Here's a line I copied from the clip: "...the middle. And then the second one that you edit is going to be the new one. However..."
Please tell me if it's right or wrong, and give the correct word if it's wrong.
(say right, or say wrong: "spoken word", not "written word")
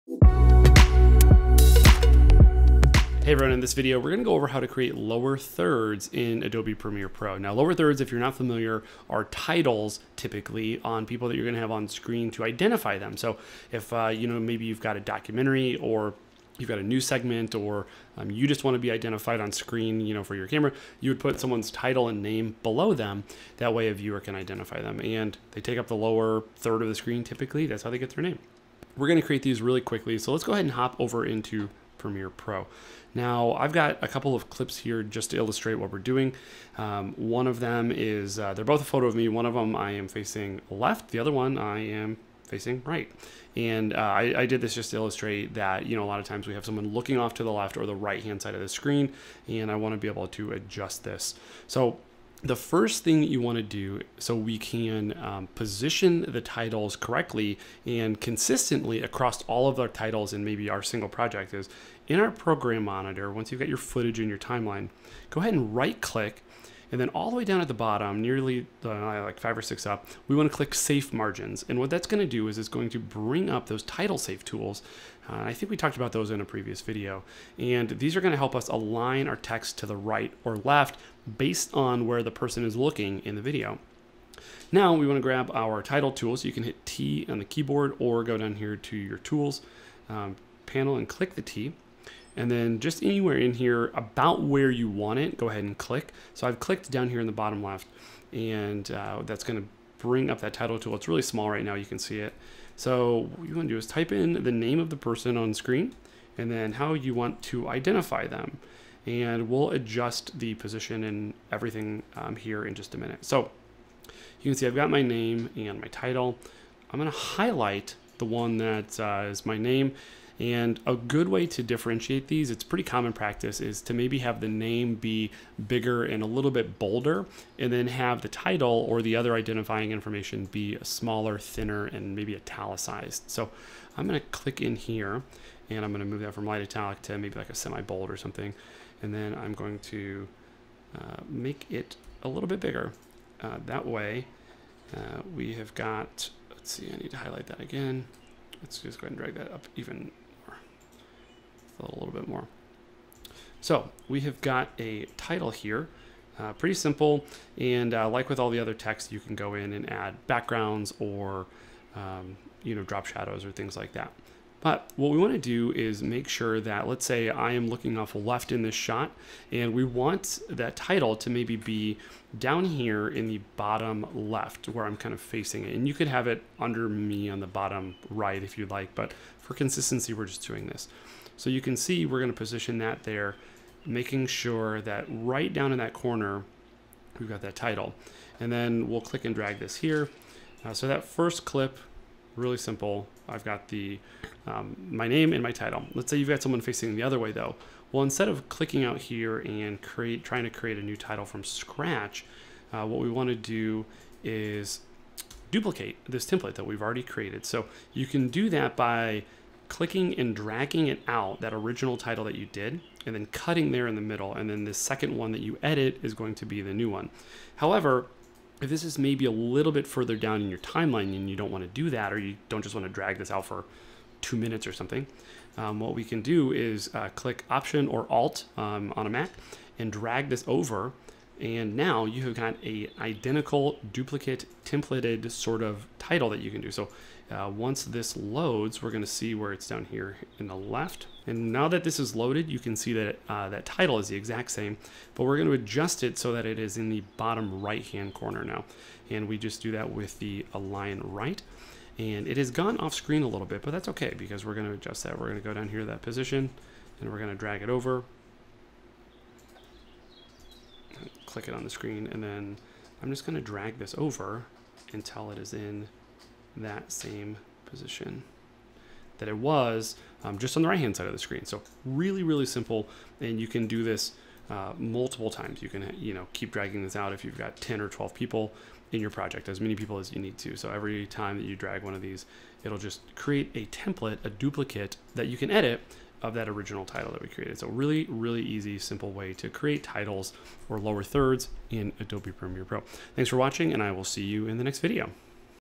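right.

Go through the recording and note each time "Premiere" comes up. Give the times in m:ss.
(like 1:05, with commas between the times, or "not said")
0:06, 0:32, 4:52.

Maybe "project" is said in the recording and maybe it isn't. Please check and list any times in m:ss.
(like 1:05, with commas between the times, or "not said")
1:01, 4:39.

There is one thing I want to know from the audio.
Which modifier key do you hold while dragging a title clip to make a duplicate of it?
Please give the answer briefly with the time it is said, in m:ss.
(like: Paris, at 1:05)
Option or Alt, at 3:47.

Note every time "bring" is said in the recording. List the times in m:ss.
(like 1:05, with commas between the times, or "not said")
1:12, 1:39.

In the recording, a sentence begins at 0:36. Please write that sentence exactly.
Um, one of them is, uh, they're both a photo of me.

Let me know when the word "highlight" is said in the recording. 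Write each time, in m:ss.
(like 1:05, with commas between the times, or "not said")
1:57, 2:27.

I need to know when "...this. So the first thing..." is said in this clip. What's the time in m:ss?
0:51.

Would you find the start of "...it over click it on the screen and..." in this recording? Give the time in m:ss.
4:17.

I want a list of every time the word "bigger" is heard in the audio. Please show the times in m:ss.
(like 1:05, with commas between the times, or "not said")
2:05, 2:22.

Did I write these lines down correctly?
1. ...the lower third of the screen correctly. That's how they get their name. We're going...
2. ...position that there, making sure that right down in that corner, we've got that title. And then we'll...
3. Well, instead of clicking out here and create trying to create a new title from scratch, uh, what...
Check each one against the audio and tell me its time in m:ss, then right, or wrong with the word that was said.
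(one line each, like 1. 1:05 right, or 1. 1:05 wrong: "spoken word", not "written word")
1. 0:25 wrong: "typically", not "correctly"
2. 3:02 right
3. 3:17 right.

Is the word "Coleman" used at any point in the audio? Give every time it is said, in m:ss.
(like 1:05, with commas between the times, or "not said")
not said.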